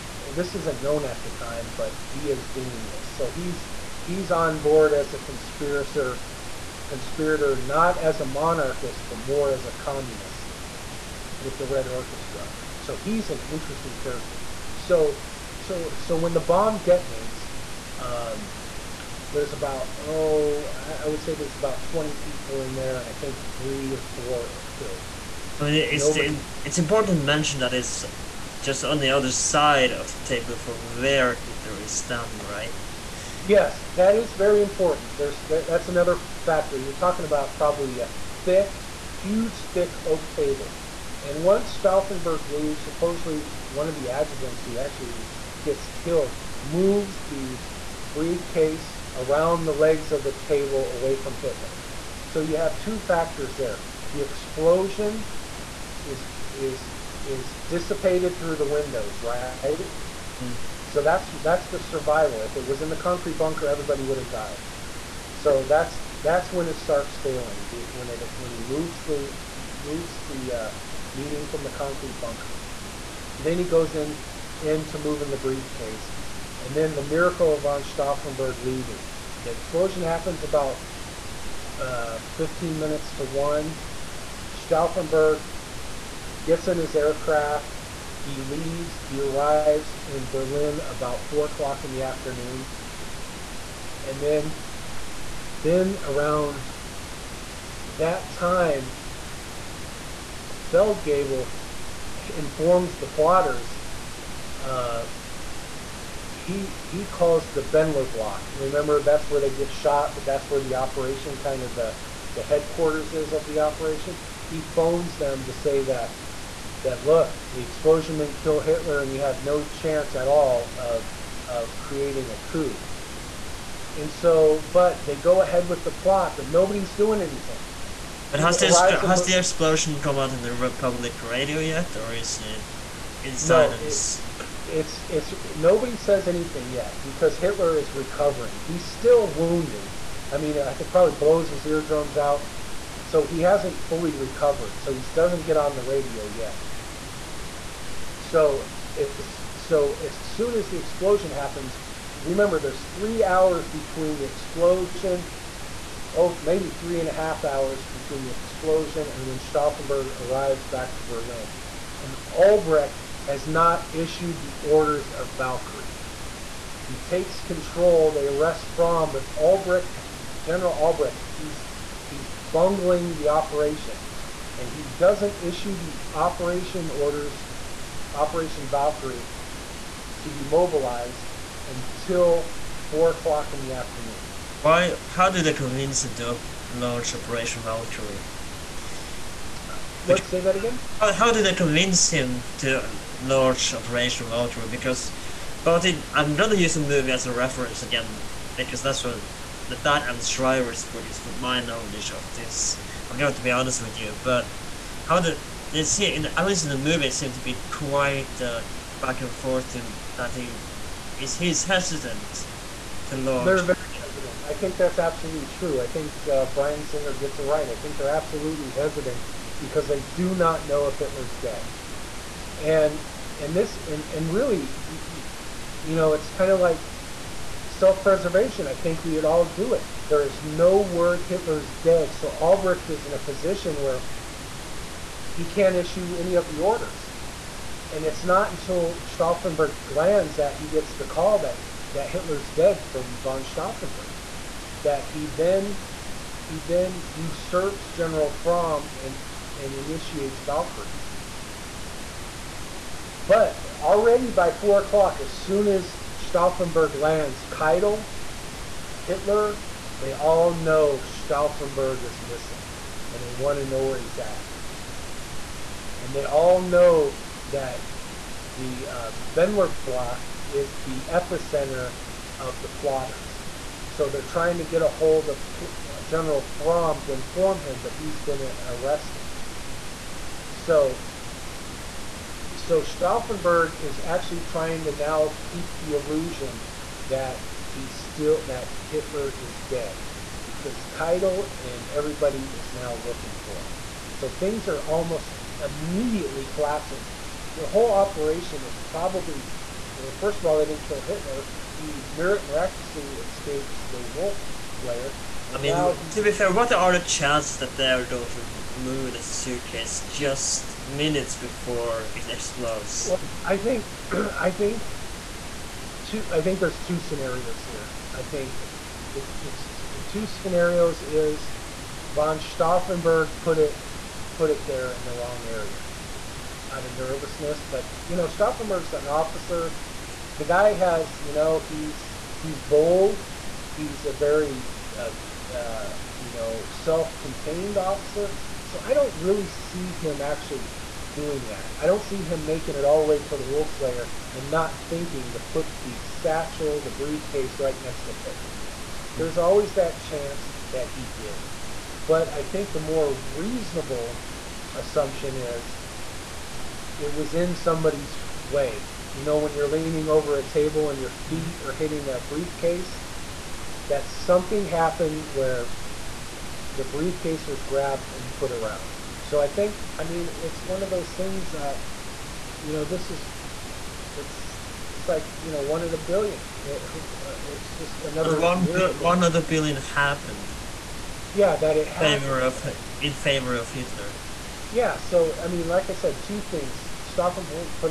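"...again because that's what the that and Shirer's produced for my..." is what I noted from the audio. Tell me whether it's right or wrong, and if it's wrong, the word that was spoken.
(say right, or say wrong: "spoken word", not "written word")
right.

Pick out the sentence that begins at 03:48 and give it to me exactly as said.
I think we would all do it.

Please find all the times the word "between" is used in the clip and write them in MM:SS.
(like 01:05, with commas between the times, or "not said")
02:33, 02:37.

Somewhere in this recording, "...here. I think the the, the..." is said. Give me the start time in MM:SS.
05:17.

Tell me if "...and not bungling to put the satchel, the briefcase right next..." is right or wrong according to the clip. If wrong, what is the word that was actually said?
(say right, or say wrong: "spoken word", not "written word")
wrong: "thinking", not "bungling".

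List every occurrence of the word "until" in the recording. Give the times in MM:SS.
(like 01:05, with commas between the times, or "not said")
03:01, 03:58.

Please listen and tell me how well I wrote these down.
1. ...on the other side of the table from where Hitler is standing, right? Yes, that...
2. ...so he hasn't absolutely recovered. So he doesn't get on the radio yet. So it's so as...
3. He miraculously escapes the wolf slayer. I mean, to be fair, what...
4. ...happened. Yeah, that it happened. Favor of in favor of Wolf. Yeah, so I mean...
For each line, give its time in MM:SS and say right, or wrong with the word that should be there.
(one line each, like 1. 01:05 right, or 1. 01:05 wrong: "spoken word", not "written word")
1. 00:28 right
2. 02:23 wrong: "fully", not "absolutely"
3. 05:01 right
4. 06:19 wrong: "Hitler", not "Wolf".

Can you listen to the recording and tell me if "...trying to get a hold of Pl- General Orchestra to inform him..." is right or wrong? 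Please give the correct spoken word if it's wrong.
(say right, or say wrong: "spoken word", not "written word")
wrong: "Fromm", not "Orchestra".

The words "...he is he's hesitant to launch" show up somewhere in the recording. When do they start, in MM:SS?
03:30.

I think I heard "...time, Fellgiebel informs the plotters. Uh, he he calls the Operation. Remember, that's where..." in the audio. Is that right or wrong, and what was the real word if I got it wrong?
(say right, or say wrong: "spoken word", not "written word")
wrong: "Bendlerblock", not "Operation".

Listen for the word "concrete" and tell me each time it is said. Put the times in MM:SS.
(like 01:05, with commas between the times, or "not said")
01:02, 01:11.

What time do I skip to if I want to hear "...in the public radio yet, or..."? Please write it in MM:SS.
02:10.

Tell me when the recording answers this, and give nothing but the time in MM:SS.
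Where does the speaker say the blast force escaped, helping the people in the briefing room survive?
00:58.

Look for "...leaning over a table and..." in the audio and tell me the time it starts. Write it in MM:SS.
05:59.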